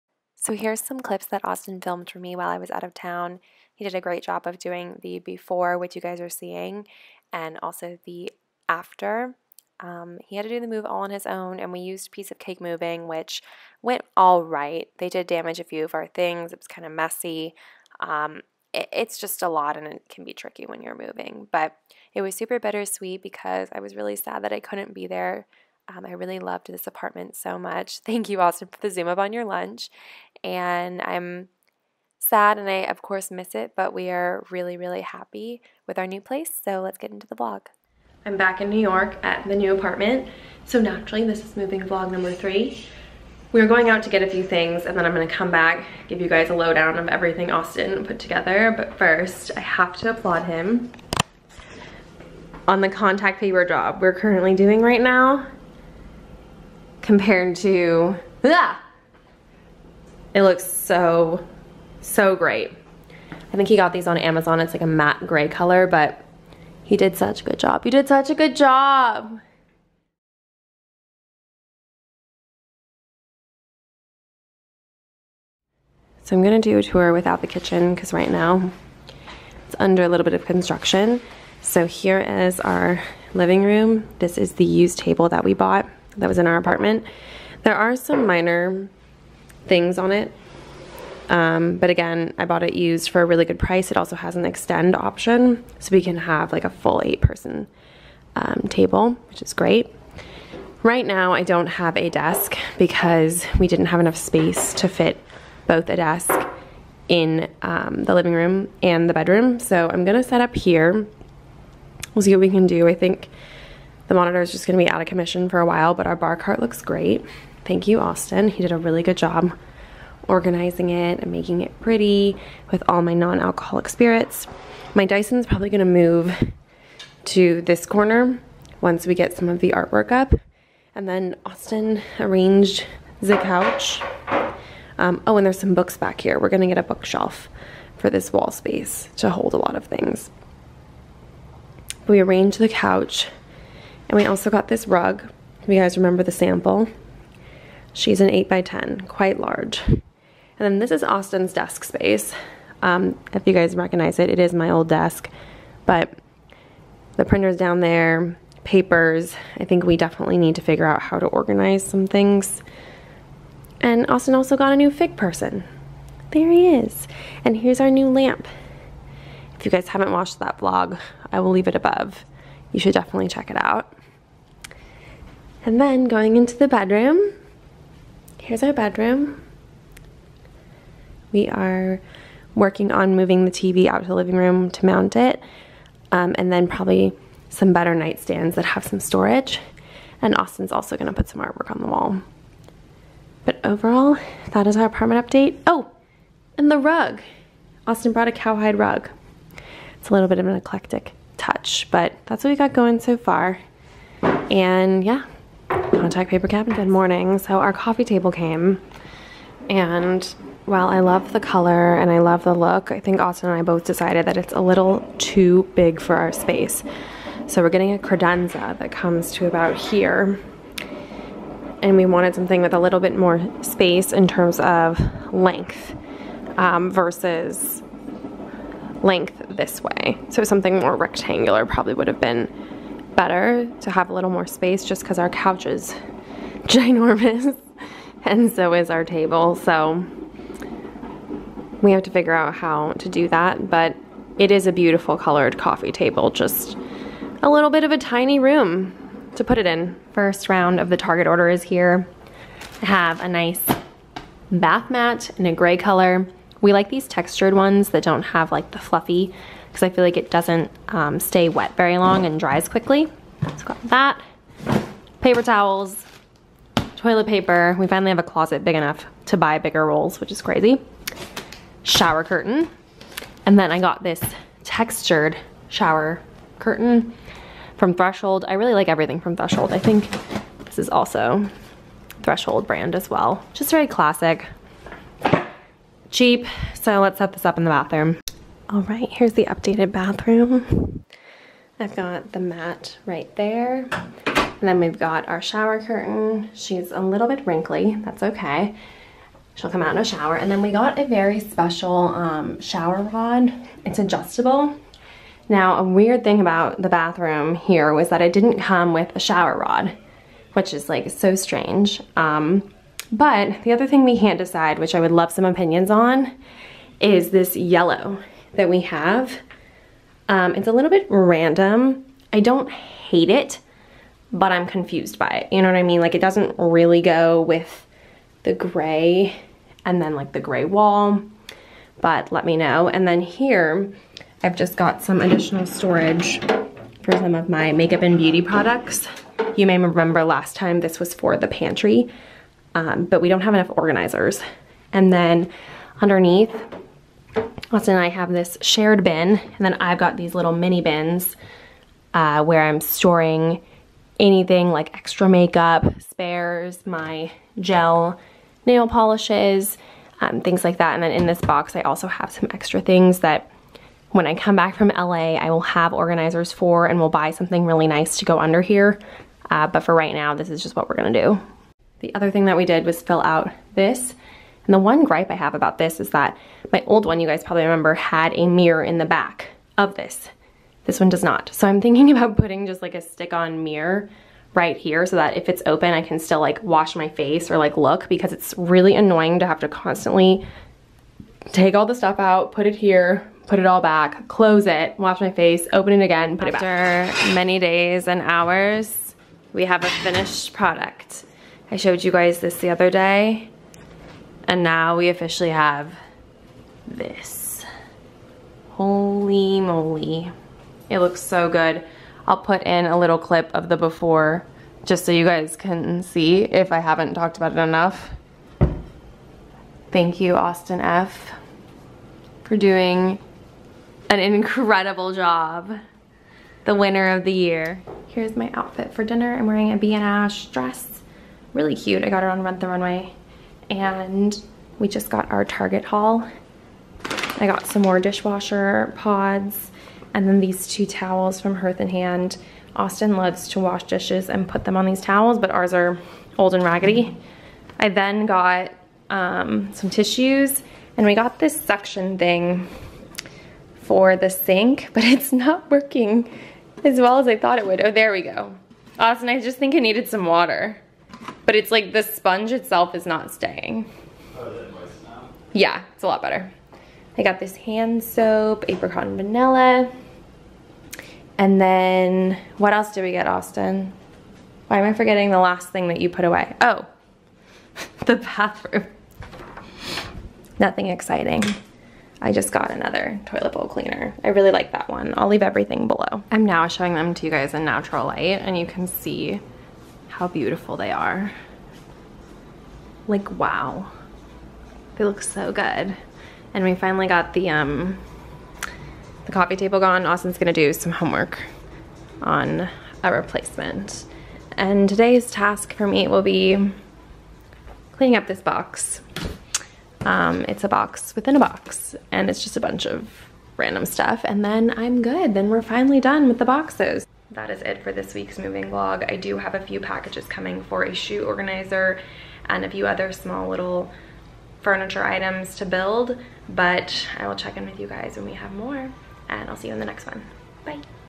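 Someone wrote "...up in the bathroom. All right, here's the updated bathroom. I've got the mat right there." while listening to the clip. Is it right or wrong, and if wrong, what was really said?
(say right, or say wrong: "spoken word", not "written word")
right.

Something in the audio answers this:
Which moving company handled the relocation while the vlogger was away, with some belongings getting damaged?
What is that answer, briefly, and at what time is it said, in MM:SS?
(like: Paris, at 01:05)
Piece of Cake Moving, at 00:12.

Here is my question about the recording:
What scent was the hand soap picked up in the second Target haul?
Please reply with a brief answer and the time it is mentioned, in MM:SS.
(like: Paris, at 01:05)
Apricot and vanilla, at 07:48.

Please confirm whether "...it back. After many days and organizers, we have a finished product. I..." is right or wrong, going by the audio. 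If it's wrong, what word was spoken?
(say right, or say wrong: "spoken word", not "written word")
wrong: "hours", not "organizers".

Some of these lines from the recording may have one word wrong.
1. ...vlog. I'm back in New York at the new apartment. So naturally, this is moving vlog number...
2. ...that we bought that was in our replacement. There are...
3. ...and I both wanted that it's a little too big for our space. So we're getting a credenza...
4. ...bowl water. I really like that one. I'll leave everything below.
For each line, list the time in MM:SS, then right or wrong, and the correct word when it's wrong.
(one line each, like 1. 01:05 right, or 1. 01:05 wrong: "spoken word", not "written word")
1. 00:37 right
2. 01:25 wrong: "apartment", not "replacement"
3. 03:33 wrong: "decided", not "wanted"
4. 08:03 wrong: "cleaner", not "water".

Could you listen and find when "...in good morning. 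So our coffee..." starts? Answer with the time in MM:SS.
03:26.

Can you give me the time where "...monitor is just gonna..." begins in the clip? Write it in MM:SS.
01:54.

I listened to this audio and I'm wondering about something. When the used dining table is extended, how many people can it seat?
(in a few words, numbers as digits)
8.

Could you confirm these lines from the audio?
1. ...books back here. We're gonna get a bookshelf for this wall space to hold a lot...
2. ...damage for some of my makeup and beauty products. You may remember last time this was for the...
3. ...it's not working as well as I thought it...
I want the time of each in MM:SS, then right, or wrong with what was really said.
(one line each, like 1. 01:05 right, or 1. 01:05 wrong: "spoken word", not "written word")
1. 02:15 right
2. 05:35 wrong: "storage", not "damage"
3. 07:35 right.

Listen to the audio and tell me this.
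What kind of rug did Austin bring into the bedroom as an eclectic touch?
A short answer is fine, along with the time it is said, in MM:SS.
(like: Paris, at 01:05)
Cowhide rug, at 03:18.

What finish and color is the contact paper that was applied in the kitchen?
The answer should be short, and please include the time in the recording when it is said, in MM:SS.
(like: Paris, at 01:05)
Matte gray, at 01:04.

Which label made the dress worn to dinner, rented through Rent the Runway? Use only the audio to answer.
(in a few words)
ba&sh.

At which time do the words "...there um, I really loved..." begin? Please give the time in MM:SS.
00:25.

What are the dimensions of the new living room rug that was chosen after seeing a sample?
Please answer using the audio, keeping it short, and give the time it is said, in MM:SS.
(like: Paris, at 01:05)
8 by 10, at 02:28.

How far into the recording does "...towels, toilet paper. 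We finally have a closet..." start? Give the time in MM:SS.
04:25.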